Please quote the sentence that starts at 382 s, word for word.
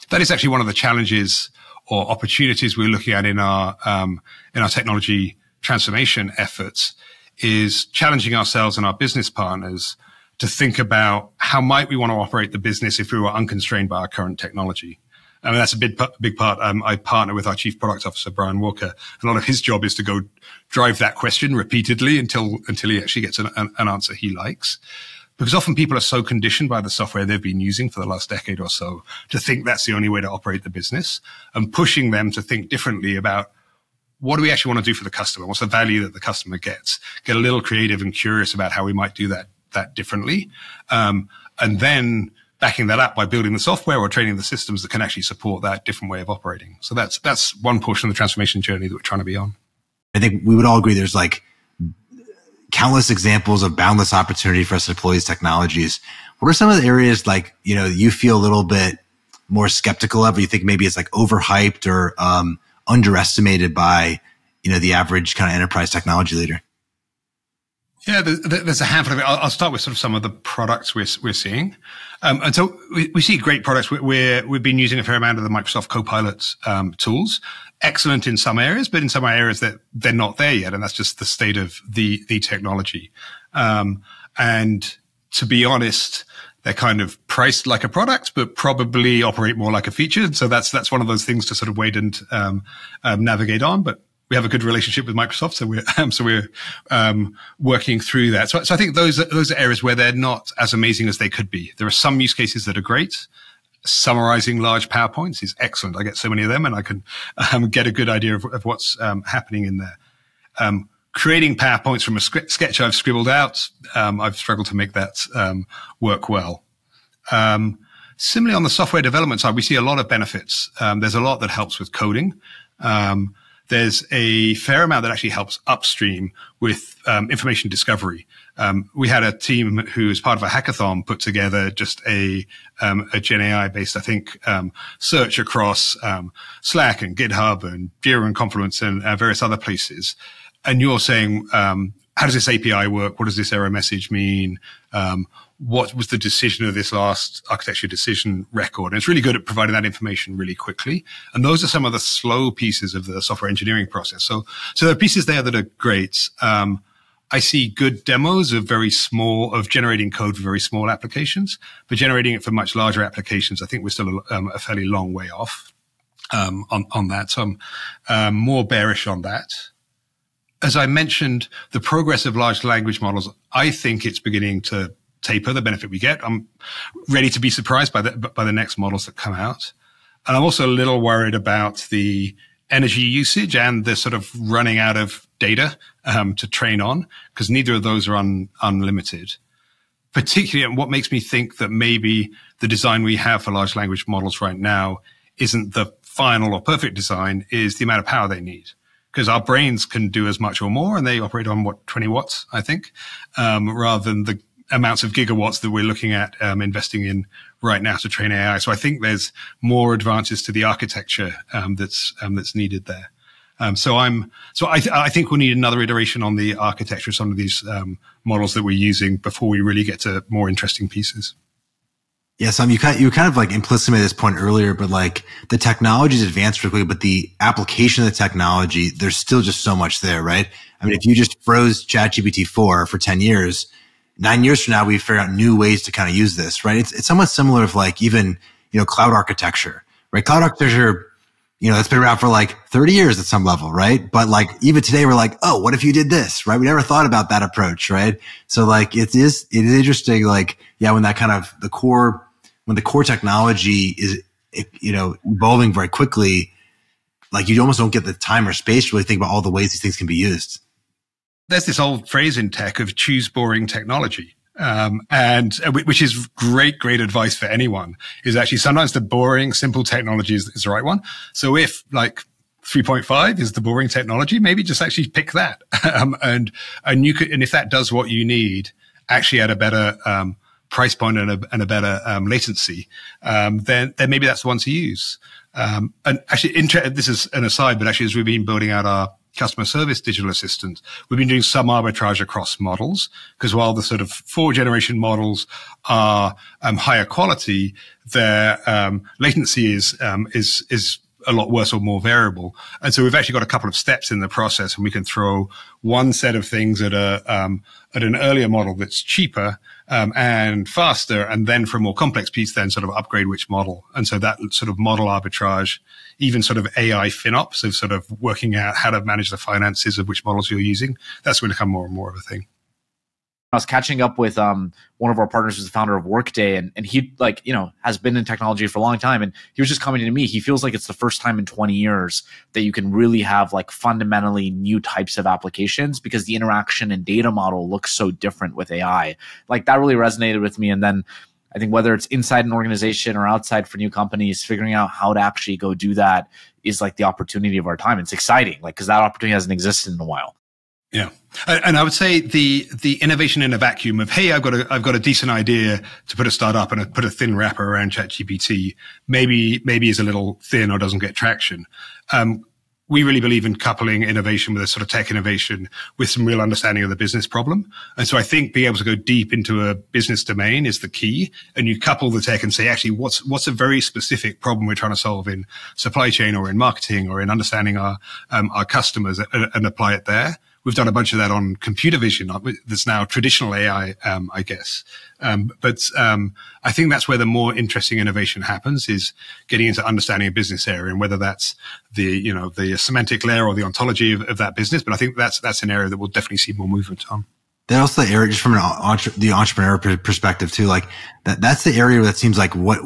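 That's now traditional AI, um, I guess.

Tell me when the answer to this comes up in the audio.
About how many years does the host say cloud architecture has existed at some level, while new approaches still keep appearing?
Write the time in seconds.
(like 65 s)
242 s.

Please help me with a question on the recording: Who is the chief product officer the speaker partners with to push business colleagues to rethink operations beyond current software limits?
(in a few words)
Brian Walker.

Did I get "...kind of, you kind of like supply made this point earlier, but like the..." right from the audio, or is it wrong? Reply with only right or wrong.
wrong.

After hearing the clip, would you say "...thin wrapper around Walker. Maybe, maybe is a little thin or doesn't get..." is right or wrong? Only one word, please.
wrong.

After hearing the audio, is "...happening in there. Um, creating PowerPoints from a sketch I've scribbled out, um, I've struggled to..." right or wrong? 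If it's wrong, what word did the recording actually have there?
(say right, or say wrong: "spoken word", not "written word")
right.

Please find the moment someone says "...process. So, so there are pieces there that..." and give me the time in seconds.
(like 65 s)
153 s.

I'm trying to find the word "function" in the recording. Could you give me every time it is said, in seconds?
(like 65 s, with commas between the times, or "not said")
not said.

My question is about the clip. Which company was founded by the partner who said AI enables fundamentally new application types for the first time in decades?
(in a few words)
Workday.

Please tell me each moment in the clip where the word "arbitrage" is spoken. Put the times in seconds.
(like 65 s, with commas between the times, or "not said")
291 s, 315 s.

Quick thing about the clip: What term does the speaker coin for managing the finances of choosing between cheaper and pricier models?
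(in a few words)
AI FinOps.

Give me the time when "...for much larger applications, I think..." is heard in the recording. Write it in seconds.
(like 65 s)
162 s.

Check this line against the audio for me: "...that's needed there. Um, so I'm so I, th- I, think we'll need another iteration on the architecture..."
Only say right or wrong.
right.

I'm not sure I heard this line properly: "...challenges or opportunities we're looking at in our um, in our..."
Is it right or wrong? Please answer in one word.
right.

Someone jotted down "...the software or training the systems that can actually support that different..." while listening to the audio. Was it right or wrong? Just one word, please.
right.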